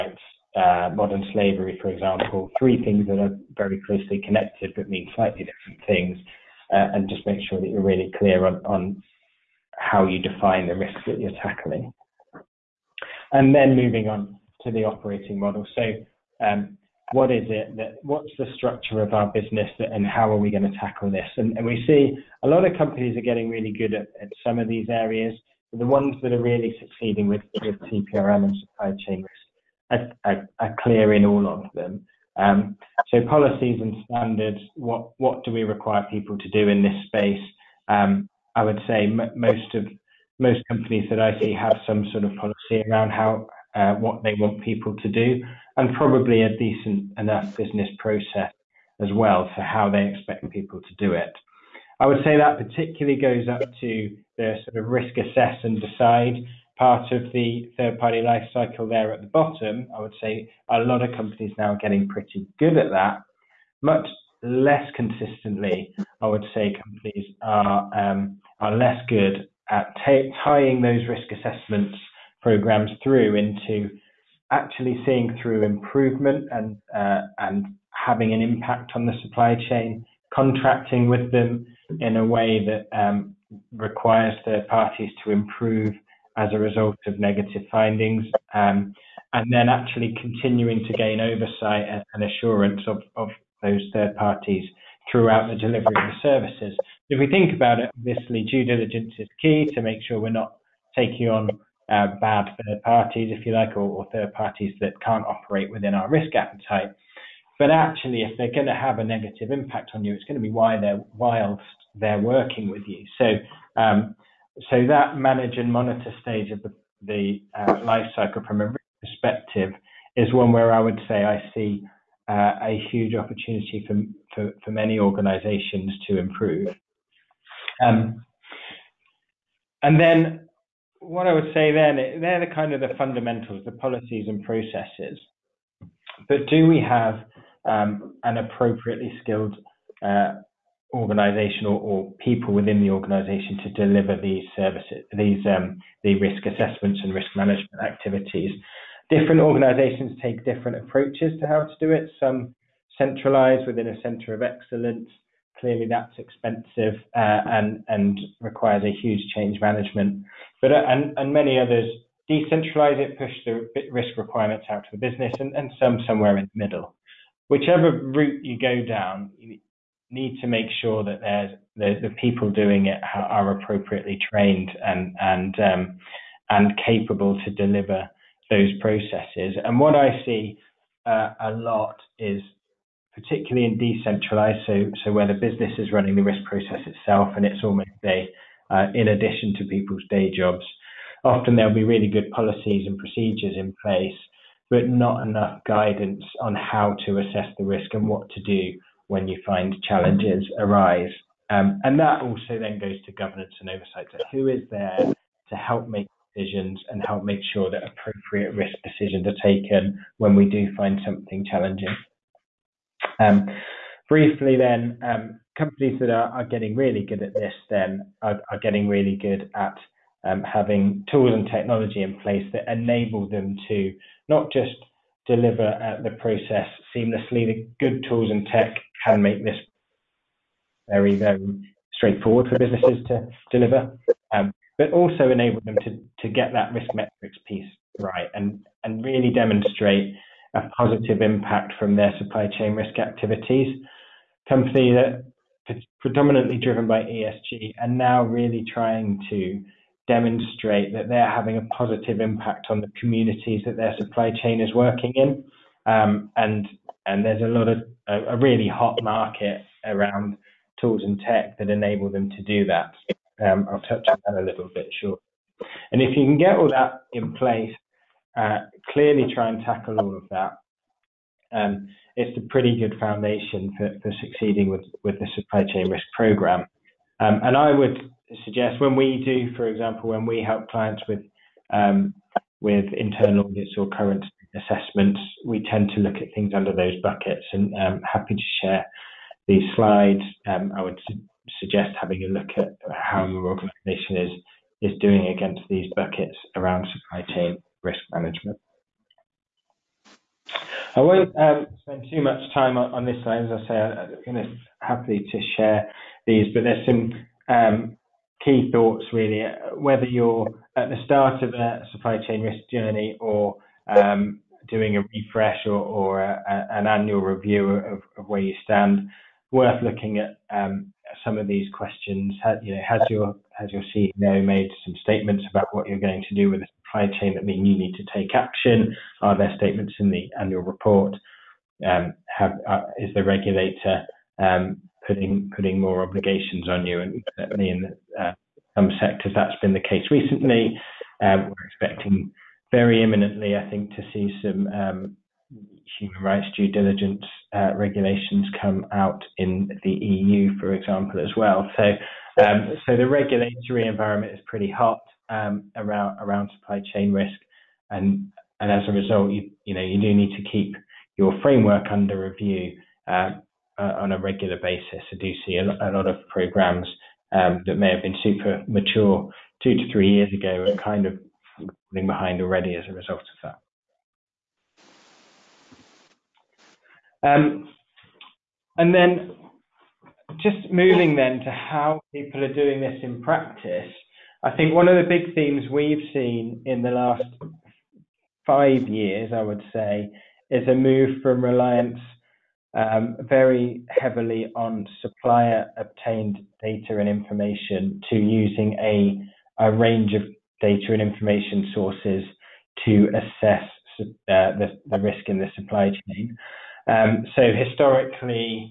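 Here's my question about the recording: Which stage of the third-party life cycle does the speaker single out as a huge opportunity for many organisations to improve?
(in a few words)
manage and monitor.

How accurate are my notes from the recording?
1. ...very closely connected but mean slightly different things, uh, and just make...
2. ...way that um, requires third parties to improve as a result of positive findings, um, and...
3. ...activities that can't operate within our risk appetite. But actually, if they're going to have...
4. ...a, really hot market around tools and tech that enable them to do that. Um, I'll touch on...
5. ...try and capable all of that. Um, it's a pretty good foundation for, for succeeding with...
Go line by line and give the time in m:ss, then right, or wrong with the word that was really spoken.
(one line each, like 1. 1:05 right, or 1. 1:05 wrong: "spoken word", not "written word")
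1. 0:03 right
2. 1:22 wrong: "negative", not "positive"
3. 1:44 wrong: "parties", not "activities"
4. 4:18 right
5. 4:29 wrong: "tackle", not "capable".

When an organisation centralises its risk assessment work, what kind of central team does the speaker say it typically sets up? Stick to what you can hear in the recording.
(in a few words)
center of excellence.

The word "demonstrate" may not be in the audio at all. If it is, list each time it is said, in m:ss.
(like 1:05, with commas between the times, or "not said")
3:59, 4:10.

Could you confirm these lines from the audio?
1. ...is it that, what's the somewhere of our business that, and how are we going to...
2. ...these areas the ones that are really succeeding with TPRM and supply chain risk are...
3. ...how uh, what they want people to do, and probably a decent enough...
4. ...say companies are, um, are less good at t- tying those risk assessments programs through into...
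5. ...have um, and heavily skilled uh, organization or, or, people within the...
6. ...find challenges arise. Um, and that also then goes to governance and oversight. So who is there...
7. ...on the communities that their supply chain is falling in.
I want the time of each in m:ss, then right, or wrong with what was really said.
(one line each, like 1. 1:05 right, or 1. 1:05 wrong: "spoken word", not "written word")
1. 0:17 wrong: "structure", not "somewhere"
2. 0:24 right
3. 0:43 right
4. 1:06 right
5. 2:16 wrong: "appropriately", not "heavily"
6. 3:19 right
7. 4:12 wrong: "working", not "falling".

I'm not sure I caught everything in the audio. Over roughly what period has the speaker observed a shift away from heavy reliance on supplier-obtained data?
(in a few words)
last 5 years.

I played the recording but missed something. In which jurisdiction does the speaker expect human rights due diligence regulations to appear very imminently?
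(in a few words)
the EU.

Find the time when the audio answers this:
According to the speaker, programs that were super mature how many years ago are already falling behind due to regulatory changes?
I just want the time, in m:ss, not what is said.
6:09.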